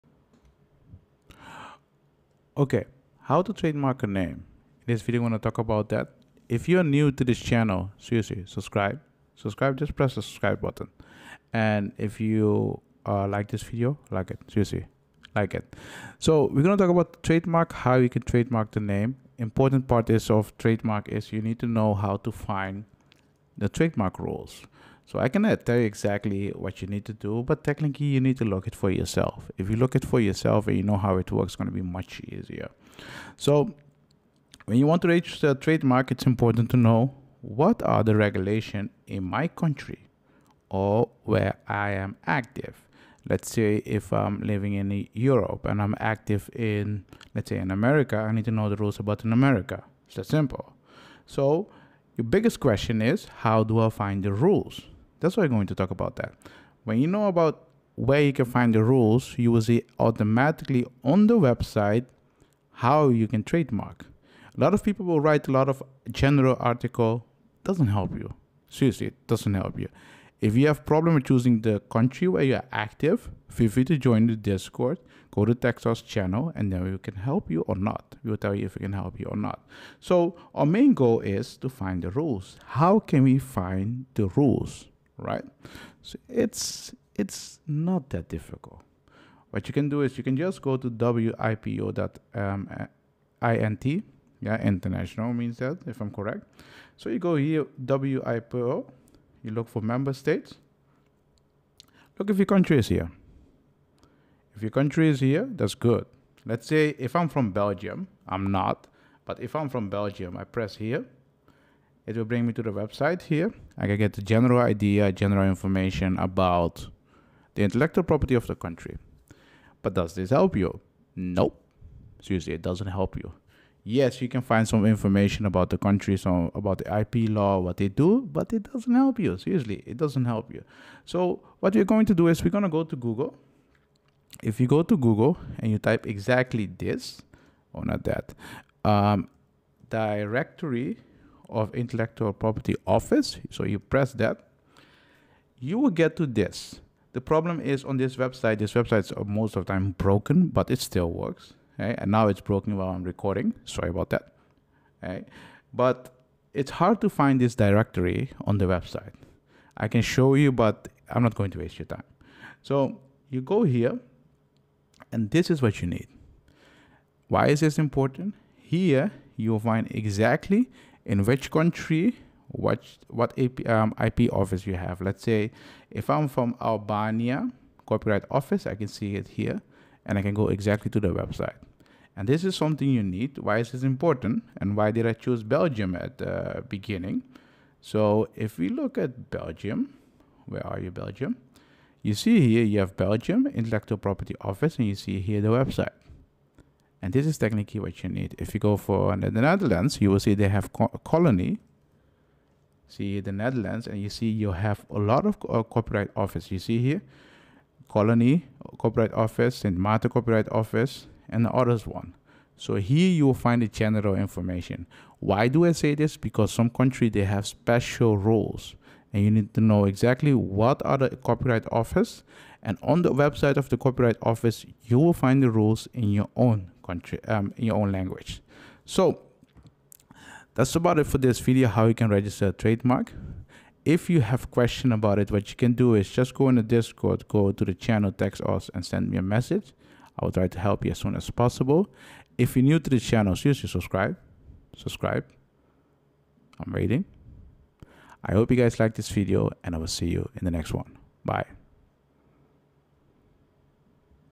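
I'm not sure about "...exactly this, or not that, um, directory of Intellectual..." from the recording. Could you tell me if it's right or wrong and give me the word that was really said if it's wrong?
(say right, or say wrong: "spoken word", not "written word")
right.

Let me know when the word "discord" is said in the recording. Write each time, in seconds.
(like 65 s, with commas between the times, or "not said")
74 s, 236 s.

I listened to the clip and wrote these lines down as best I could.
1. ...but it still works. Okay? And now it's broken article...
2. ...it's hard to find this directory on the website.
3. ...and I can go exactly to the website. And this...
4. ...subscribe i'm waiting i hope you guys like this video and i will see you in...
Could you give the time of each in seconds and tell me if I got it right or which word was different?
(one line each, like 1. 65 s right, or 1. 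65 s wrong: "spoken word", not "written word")
1. 150 s wrong: "while", not "article"
2. 156 s right
3. 180 s right
4. 244 s right.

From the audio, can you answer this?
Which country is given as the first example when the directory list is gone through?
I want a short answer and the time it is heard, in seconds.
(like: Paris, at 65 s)
Albania, at 176 s.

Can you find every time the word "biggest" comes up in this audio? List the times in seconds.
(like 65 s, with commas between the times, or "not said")
52 s.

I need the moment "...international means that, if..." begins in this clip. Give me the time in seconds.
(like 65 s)
94 s.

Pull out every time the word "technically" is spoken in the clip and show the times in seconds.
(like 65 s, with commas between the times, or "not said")
27 s, 197 s.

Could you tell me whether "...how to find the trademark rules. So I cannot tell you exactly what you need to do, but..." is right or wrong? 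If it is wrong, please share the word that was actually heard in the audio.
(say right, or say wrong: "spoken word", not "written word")
right.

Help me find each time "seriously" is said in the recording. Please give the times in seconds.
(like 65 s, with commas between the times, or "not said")
7 s, 14 s, 68 s, 122 s, 129 s, 243 s.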